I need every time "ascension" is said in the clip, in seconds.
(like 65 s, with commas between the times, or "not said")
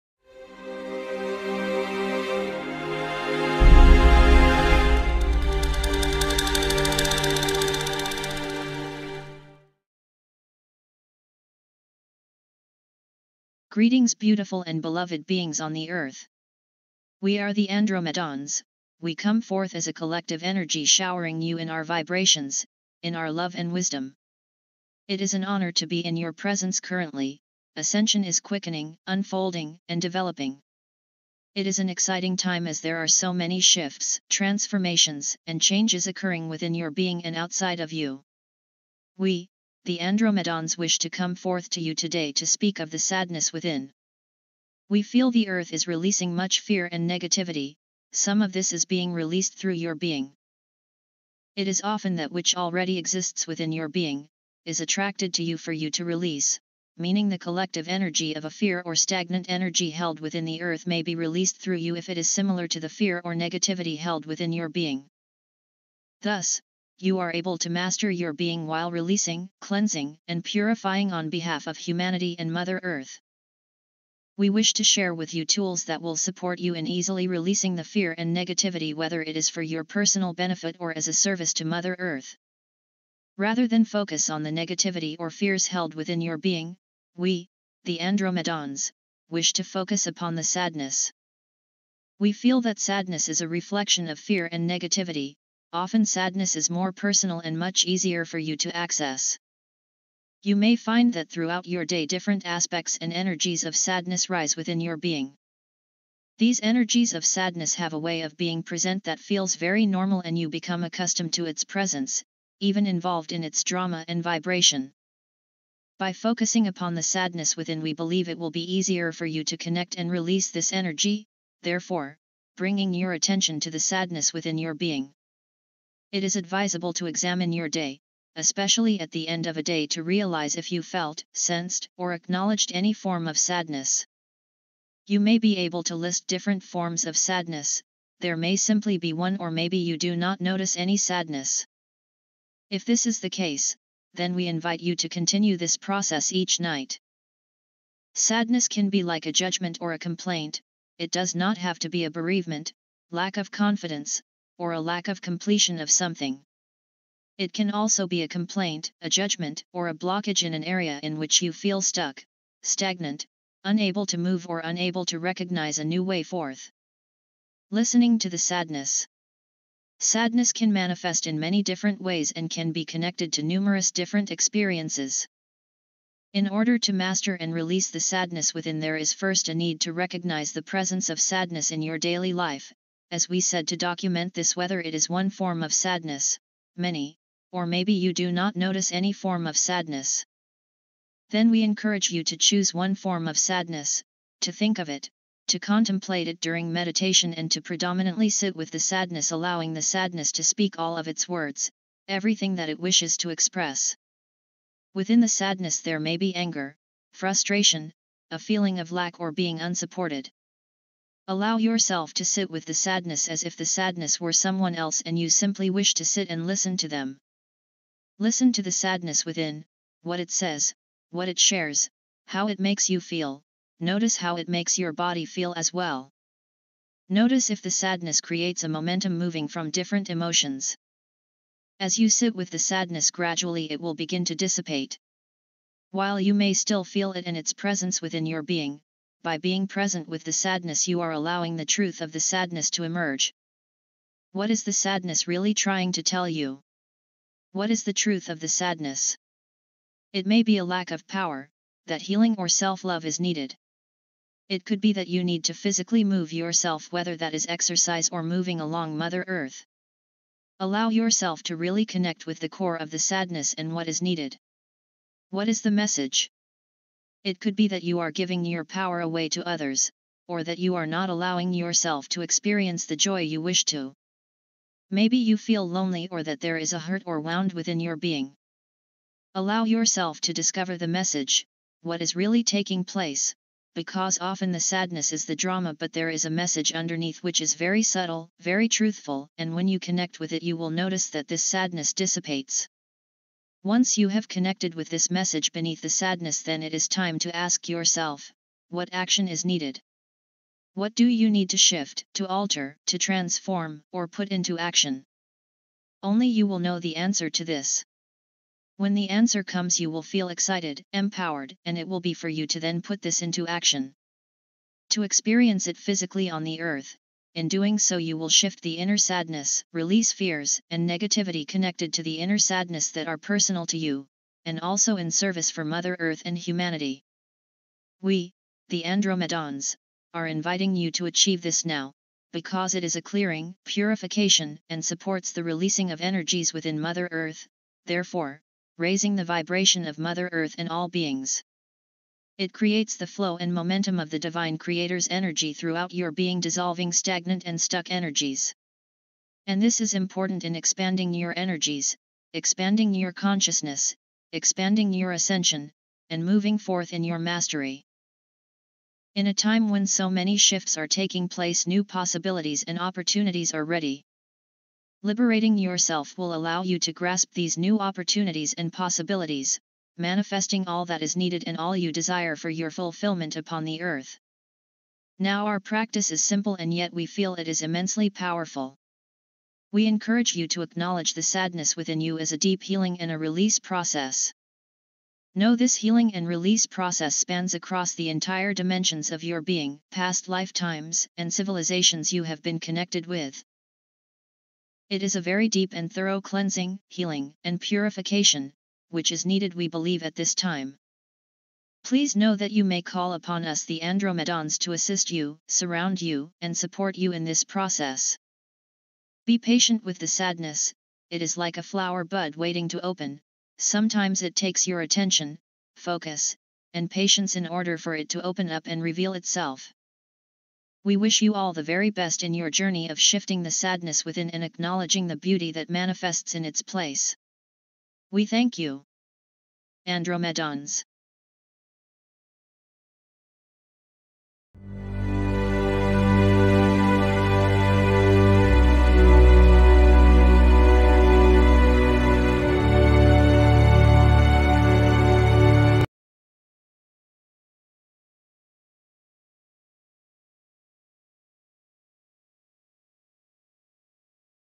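27 s, 355 s.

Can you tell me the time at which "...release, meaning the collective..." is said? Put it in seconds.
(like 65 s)
56 s.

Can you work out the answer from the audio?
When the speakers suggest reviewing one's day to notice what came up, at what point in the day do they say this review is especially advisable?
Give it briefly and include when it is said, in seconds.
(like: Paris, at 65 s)
At the end of a day, at 129 s.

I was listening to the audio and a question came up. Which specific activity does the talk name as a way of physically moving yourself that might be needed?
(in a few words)
Exercise.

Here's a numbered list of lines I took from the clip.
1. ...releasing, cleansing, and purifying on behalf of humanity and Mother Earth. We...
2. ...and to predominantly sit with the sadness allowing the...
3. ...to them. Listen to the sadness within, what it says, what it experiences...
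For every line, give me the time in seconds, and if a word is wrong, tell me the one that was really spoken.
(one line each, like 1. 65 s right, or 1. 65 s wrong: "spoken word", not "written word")
1. 68 s right
2. 197 s right
3. 216 s wrong: "shares", not "experiences".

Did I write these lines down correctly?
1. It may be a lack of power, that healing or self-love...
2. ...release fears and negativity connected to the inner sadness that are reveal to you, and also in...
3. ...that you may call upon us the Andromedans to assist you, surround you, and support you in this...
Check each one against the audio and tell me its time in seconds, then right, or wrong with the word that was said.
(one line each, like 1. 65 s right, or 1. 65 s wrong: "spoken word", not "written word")
1. 250 s right
2. 319 s wrong: "personal", not "reveal"
3. 402 s right.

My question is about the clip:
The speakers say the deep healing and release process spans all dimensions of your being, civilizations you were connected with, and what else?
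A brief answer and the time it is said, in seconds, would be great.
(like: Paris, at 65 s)
Past lifetimes, at 389 s.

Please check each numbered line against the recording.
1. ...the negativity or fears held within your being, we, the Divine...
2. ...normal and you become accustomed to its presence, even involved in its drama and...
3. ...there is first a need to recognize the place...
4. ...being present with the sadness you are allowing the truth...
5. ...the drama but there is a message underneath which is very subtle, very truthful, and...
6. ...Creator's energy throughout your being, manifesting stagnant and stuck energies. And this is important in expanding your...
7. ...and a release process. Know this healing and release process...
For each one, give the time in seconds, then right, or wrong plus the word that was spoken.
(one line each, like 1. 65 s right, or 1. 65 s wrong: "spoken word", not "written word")
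1. 84 s wrong: "Andromedans", not "Divine"
2. 109 s right
3. 178 s wrong: "presence", not "place"
4. 239 s right
5. 285 s right
6. 344 s wrong: "dissolving", not "manifesting"
7. 382 s right.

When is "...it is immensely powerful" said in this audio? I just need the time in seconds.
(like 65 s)
377 s.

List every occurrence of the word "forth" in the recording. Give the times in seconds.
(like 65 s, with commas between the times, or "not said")
19 s, 41 s, 166 s, 356 s.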